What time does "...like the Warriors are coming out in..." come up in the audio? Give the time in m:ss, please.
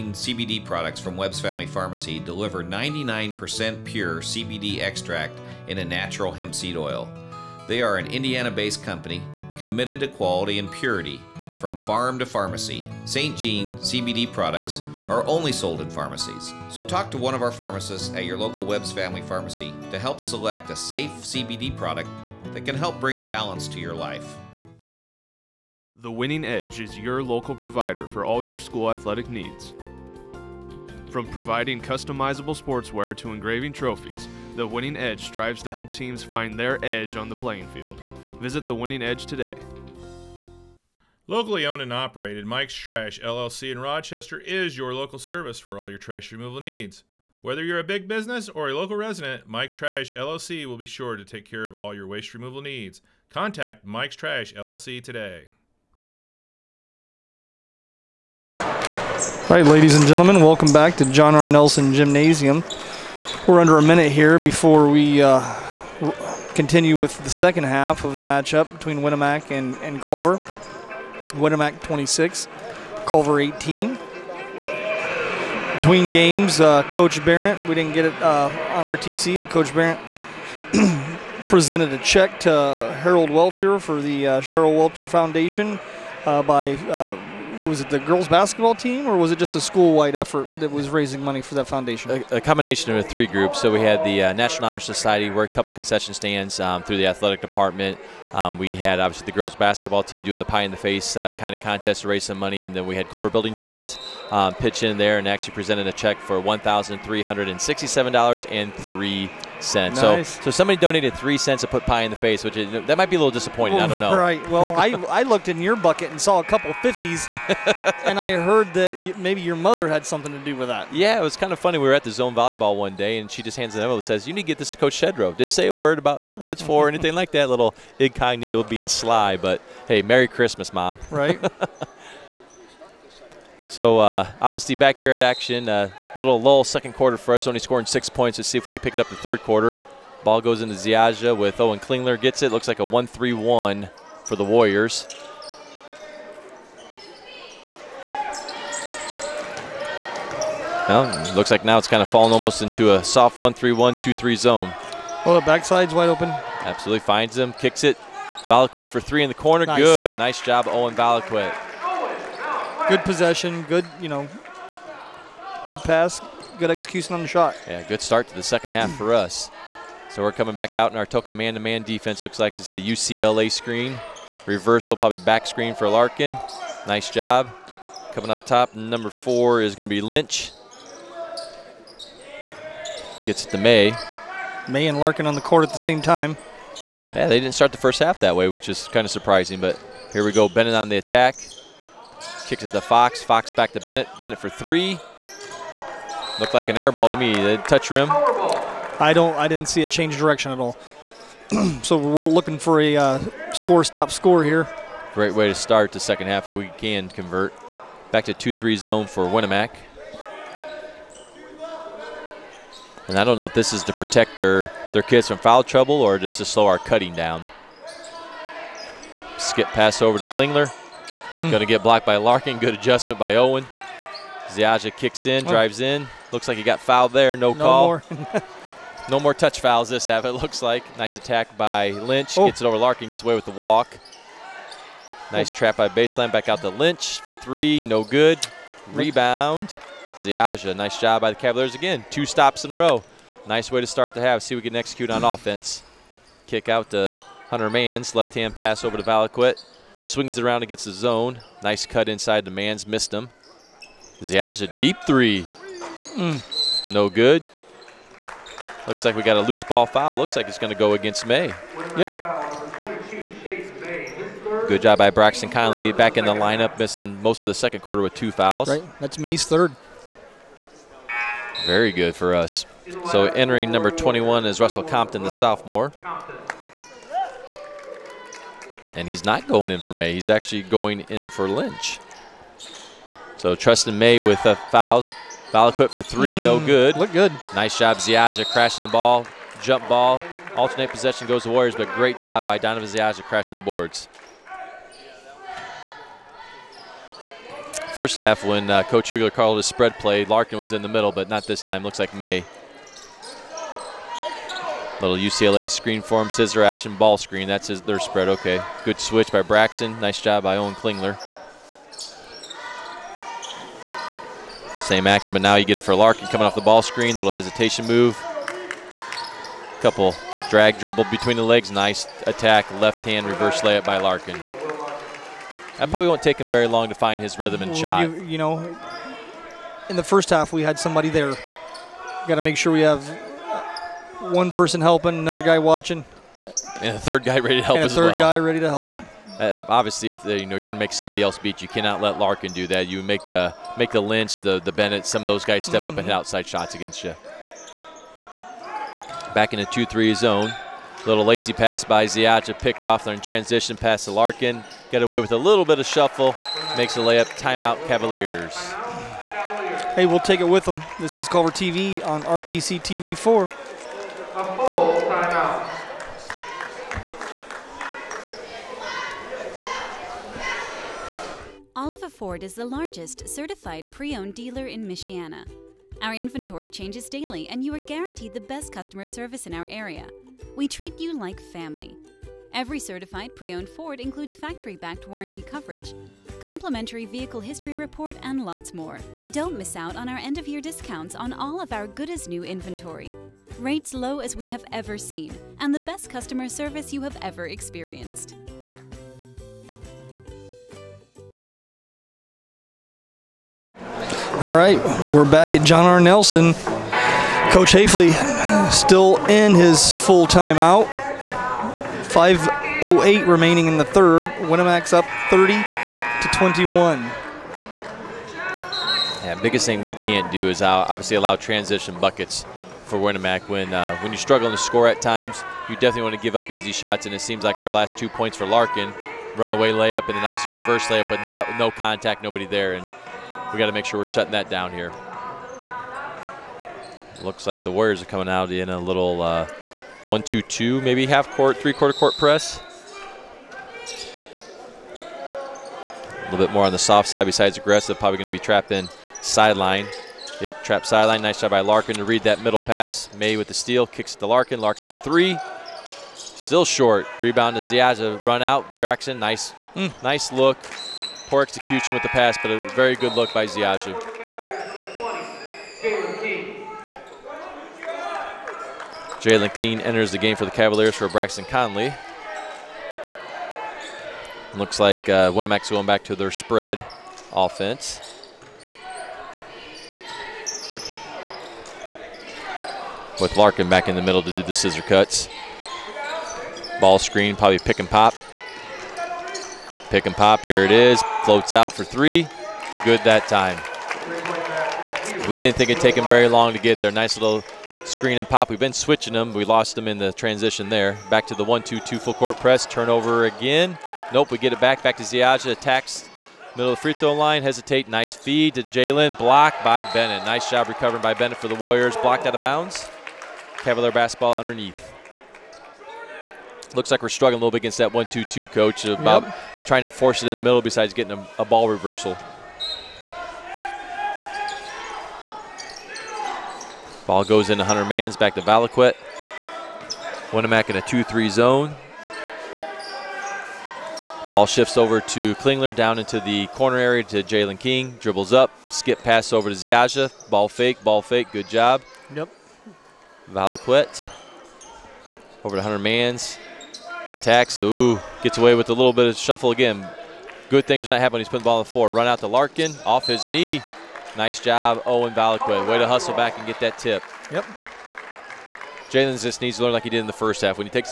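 7:17.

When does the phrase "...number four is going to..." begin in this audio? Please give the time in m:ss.
2:58.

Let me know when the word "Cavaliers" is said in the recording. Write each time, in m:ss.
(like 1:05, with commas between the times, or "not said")
4:01, 5:57, 7:50, 8:33.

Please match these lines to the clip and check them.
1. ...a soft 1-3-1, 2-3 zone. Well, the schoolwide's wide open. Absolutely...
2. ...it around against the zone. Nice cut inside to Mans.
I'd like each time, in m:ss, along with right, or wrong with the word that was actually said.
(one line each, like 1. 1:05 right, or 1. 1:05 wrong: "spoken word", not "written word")
1. 2:32 wrong: "backside", not "schoolwide"
2. 4:10 right.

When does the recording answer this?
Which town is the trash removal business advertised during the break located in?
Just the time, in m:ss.
0:43.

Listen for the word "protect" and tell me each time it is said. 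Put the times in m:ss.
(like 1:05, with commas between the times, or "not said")
3:33.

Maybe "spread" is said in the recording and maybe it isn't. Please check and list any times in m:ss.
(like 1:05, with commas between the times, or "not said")
4:59, 5:07, 7:56.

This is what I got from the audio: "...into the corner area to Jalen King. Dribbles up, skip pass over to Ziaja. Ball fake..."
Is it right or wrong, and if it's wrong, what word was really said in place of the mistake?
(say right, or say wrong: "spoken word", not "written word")
right.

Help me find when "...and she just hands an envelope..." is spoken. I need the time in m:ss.
2:03.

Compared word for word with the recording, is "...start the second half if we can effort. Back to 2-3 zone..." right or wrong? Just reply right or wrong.
wrong.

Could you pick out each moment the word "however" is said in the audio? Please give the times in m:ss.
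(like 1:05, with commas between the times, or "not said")
not said.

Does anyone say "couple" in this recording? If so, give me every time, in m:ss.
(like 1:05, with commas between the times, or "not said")
1:35, 1:56, 5:19.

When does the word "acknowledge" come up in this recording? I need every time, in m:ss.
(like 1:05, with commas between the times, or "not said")
not said.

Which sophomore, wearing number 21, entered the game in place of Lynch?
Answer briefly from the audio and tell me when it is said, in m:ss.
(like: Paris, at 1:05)
Russell Compton, at 4:34.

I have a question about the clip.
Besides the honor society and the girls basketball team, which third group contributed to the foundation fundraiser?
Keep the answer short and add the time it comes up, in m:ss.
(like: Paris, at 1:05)
Culver Building Trades, at 1:43.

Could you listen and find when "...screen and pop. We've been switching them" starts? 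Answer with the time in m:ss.
8:17.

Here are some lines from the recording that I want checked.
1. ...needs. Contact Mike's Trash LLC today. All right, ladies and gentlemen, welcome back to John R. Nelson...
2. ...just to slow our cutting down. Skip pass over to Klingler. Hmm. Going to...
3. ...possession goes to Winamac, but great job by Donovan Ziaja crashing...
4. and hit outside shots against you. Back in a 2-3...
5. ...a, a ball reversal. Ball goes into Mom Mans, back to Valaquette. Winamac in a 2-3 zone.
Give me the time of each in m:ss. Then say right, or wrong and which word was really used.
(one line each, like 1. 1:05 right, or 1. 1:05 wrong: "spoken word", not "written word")
1. 0:52 right
2. 3:36 right
3. 4:50 wrong: "Warriors", not "Winamac"
4. 5:45 right
5. 8:41 wrong: "Hunter", not "Mom".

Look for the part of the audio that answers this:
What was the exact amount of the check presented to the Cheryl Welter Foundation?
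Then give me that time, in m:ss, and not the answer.
1:46.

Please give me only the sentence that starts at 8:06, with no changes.
Ball screen, probably pick and pop.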